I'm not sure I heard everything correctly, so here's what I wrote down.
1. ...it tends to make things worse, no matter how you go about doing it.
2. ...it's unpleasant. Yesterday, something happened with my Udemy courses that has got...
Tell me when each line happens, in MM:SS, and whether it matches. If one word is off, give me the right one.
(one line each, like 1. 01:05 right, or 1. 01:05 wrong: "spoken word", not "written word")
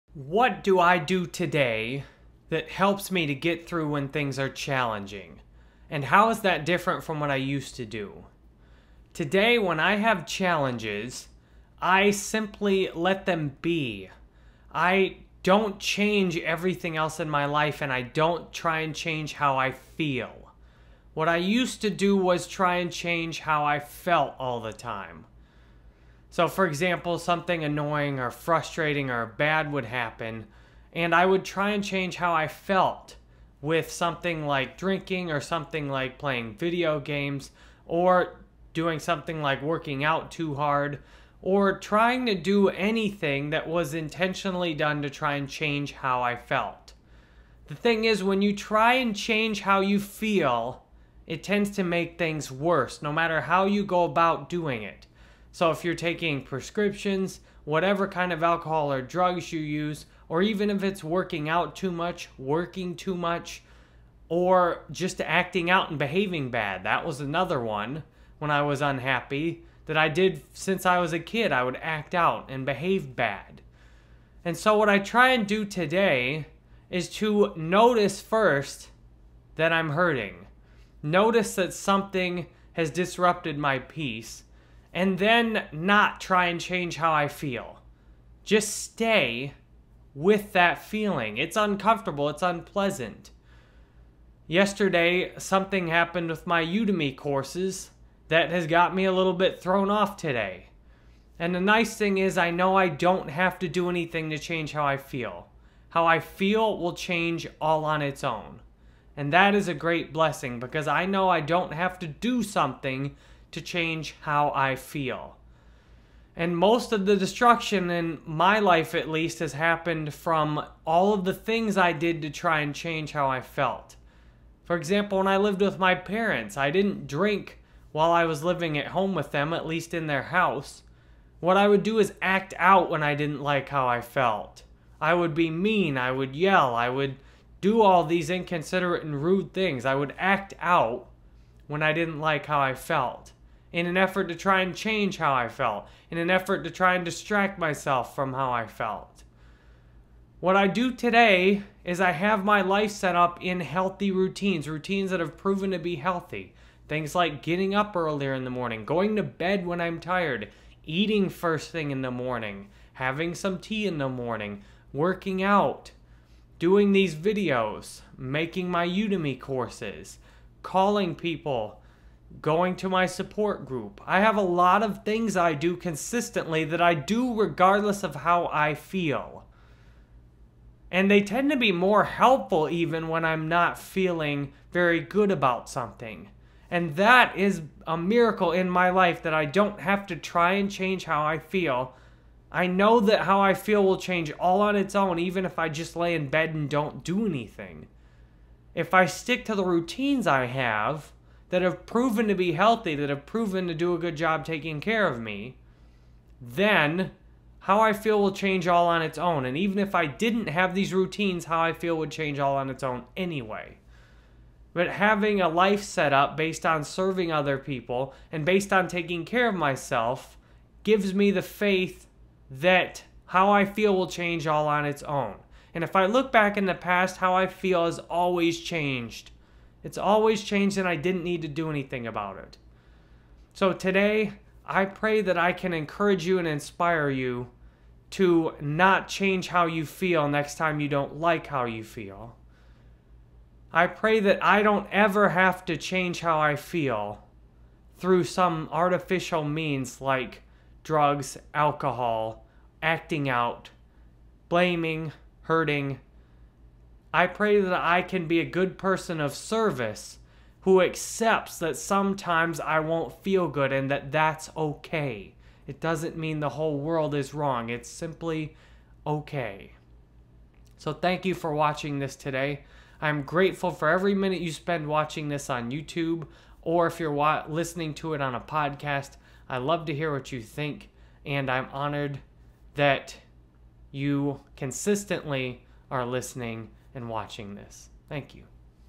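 1. 00:51 right
2. 01:32 right.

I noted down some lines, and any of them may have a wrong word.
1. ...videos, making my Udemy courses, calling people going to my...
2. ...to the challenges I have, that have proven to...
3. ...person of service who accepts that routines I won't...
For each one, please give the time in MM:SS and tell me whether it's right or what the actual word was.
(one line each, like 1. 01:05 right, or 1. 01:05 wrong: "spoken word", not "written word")
1. 02:47 right
2. 03:19 wrong: "routines", not "challenges"
3. 04:18 wrong: "sometimes", not "routines".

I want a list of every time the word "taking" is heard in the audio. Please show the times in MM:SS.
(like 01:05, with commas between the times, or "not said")
00:55, 03:24, 03:38.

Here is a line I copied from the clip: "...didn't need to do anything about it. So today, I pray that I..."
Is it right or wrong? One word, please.
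right.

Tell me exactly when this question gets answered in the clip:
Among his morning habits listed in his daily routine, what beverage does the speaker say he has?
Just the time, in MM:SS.
02:43.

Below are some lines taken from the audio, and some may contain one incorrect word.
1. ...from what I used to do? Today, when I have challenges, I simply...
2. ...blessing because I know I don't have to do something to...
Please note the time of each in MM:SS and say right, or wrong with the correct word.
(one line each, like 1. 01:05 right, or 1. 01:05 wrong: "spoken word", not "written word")
1. 00:07 right
2. 01:50 right.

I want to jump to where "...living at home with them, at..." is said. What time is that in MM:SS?
02:08.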